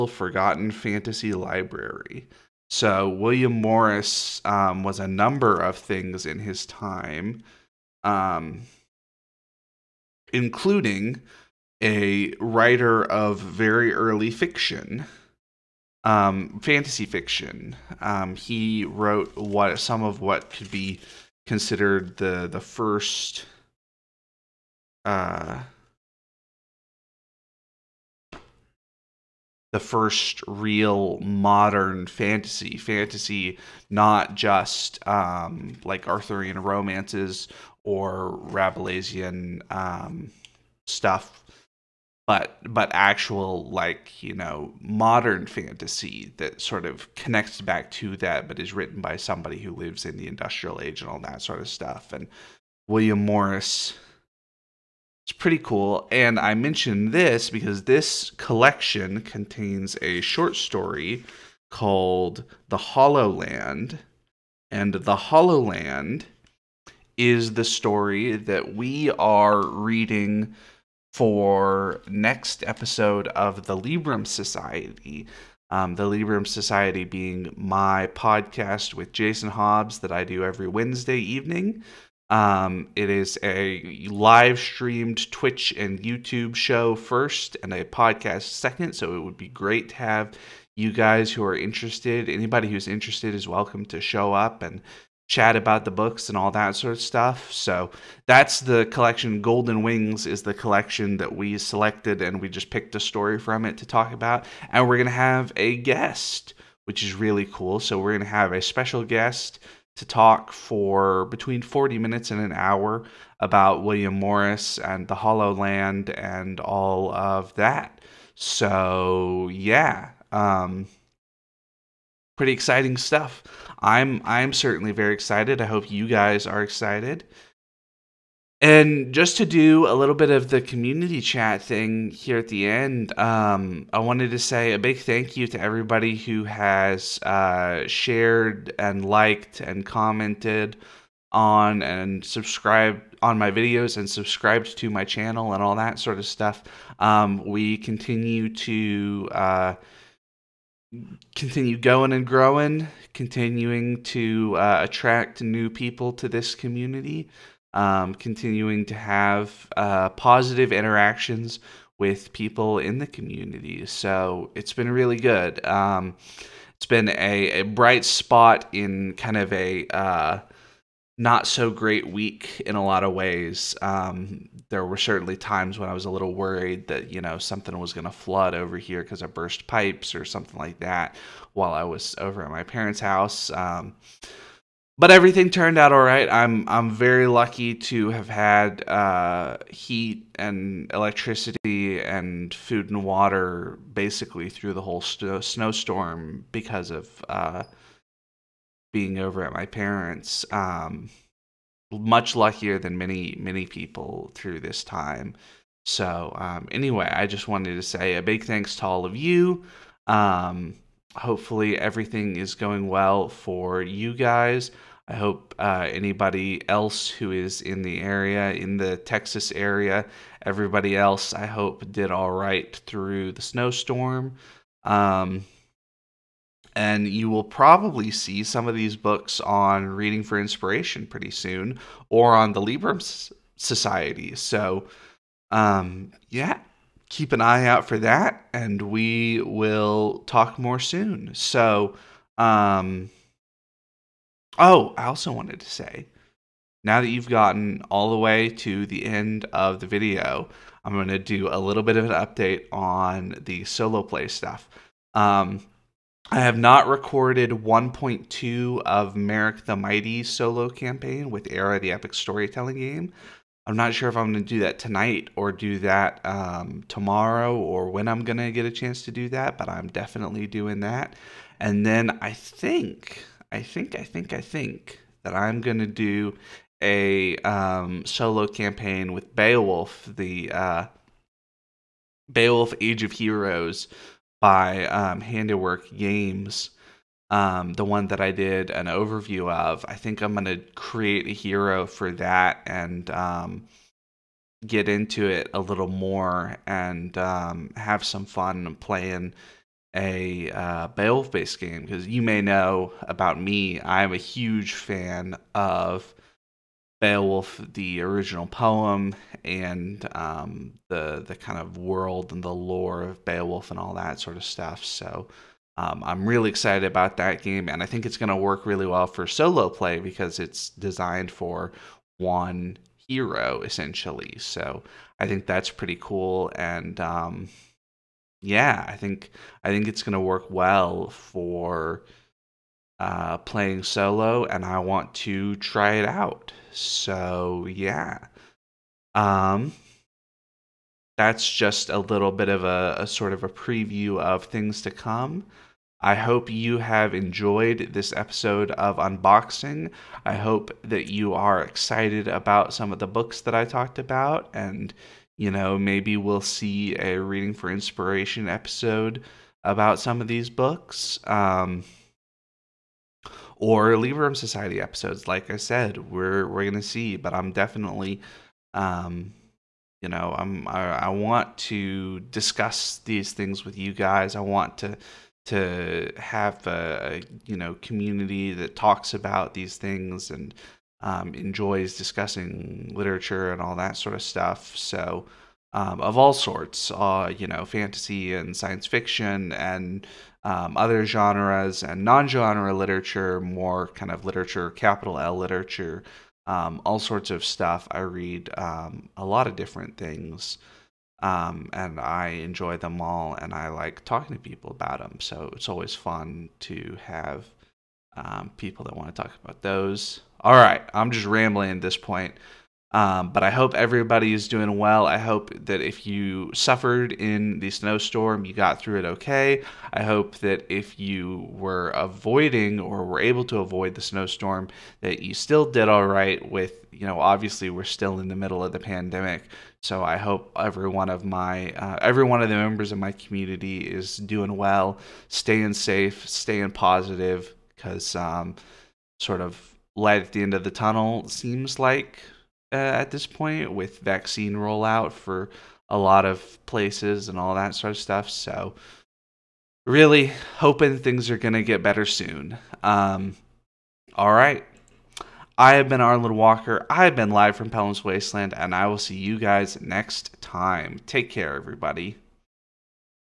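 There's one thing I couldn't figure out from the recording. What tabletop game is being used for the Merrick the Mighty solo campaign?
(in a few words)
Era.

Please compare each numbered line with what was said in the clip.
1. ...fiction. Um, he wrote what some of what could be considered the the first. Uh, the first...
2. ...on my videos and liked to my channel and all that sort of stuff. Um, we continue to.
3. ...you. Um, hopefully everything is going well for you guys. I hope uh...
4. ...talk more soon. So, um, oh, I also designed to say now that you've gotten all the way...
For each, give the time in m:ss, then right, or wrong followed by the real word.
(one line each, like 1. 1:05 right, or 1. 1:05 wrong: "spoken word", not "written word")
1. 0:17 right
2. 2:23 wrong: "subscribed", not "liked"
3. 3:29 right
4. 4:00 wrong: "wanted", not "designed".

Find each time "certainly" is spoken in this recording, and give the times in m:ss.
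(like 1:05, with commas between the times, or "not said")
2:04, 2:54.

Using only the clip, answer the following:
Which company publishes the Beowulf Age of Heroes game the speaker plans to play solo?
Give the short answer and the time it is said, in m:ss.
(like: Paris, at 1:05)
Handiwork Games, at 4:45.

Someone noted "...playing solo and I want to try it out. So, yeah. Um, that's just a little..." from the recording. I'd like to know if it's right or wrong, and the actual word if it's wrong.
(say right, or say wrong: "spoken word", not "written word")
right.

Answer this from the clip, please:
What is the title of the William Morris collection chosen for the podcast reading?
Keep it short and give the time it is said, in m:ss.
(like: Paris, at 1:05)
Golden Wings, at 1:39.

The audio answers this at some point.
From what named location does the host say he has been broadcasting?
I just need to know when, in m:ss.
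7:37.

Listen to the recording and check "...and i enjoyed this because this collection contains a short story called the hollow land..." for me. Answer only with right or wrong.
wrong.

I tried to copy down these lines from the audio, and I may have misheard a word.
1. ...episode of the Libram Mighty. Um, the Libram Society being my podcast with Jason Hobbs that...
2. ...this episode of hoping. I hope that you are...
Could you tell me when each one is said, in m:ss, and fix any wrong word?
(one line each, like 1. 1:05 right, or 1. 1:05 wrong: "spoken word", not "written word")
1. 1:12 wrong: "Society", not "Mighty"
2. 5:47 wrong: "unboxing", not "hoping".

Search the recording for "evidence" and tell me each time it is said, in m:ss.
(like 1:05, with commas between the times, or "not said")
not said.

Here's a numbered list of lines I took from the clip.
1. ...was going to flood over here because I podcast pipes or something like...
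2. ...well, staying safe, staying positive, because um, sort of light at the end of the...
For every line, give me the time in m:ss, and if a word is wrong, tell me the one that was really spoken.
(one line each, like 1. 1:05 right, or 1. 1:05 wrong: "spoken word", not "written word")
1. 2:57 wrong: "burst", not "podcast"
2. 7:14 right.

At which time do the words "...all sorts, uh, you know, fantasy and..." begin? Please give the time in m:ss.
6:26.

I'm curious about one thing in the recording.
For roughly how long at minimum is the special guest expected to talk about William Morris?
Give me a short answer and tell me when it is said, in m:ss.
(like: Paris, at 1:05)
40 minutes, at 1:51.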